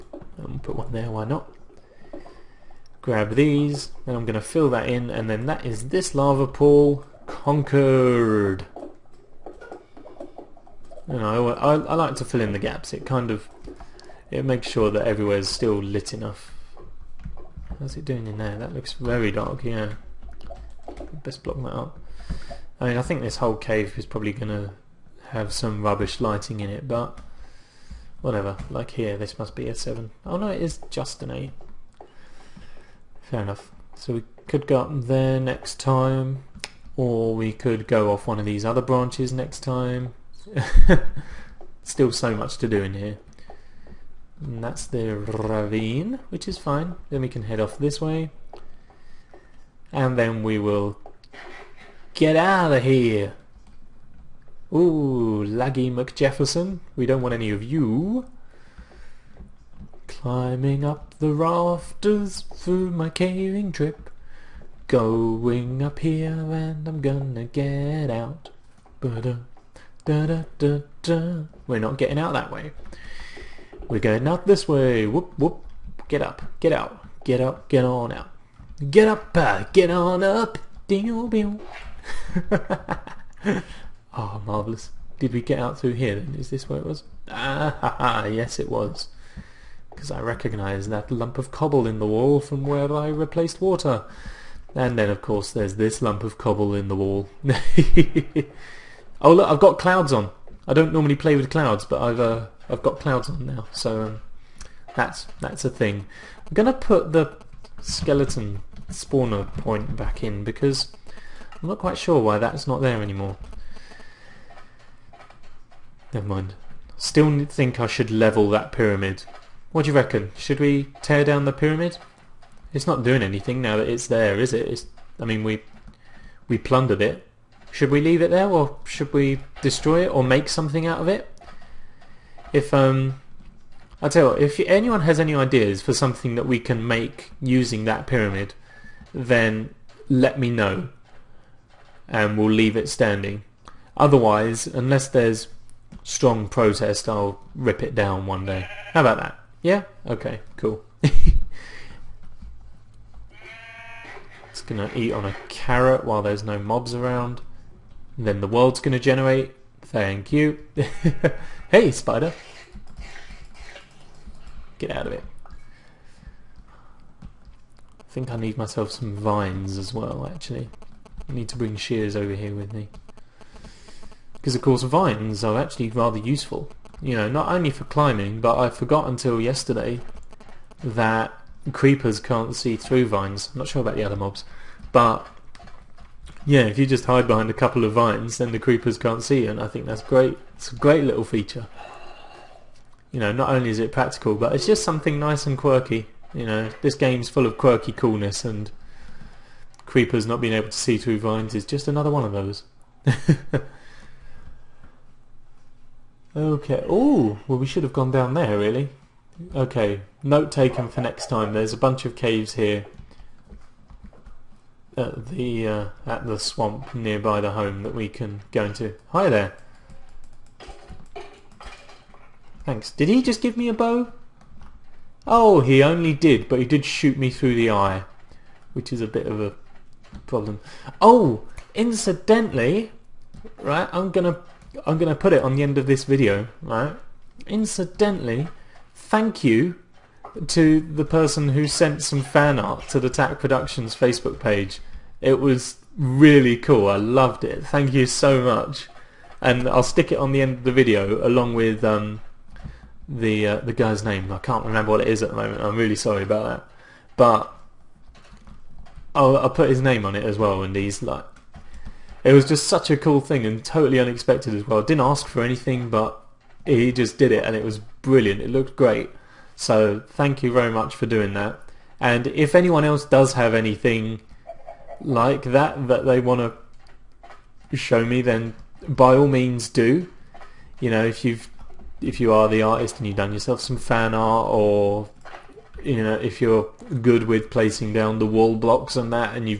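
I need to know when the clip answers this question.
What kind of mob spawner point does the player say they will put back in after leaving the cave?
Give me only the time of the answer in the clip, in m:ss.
1:47.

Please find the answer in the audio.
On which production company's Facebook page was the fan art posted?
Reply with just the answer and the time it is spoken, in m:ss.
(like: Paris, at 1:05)
Tack Productions, at 4:03.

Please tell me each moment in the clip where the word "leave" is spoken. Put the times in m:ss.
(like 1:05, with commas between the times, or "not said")
2:08, 2:22.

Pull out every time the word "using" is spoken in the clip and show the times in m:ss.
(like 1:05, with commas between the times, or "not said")
2:17.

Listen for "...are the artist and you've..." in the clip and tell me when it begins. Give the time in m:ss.
4:42.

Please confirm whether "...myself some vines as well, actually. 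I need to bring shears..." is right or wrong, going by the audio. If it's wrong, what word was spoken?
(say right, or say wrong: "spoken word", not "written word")
right.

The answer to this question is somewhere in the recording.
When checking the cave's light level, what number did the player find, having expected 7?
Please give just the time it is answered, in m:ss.
0:30.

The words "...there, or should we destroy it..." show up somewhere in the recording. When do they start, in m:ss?
2:08.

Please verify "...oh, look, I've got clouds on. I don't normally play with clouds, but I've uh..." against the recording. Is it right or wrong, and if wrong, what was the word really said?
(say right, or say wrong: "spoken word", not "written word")
right.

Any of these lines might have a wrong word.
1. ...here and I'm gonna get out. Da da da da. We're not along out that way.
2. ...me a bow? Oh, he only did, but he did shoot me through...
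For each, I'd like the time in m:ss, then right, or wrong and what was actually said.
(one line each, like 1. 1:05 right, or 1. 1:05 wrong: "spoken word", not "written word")
1. 1:05 wrong: "getting", not "along"
2. 3:43 right.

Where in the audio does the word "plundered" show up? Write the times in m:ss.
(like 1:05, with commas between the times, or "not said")
2:06.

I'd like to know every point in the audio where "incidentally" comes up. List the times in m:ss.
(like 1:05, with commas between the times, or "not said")
3:51, 3:57.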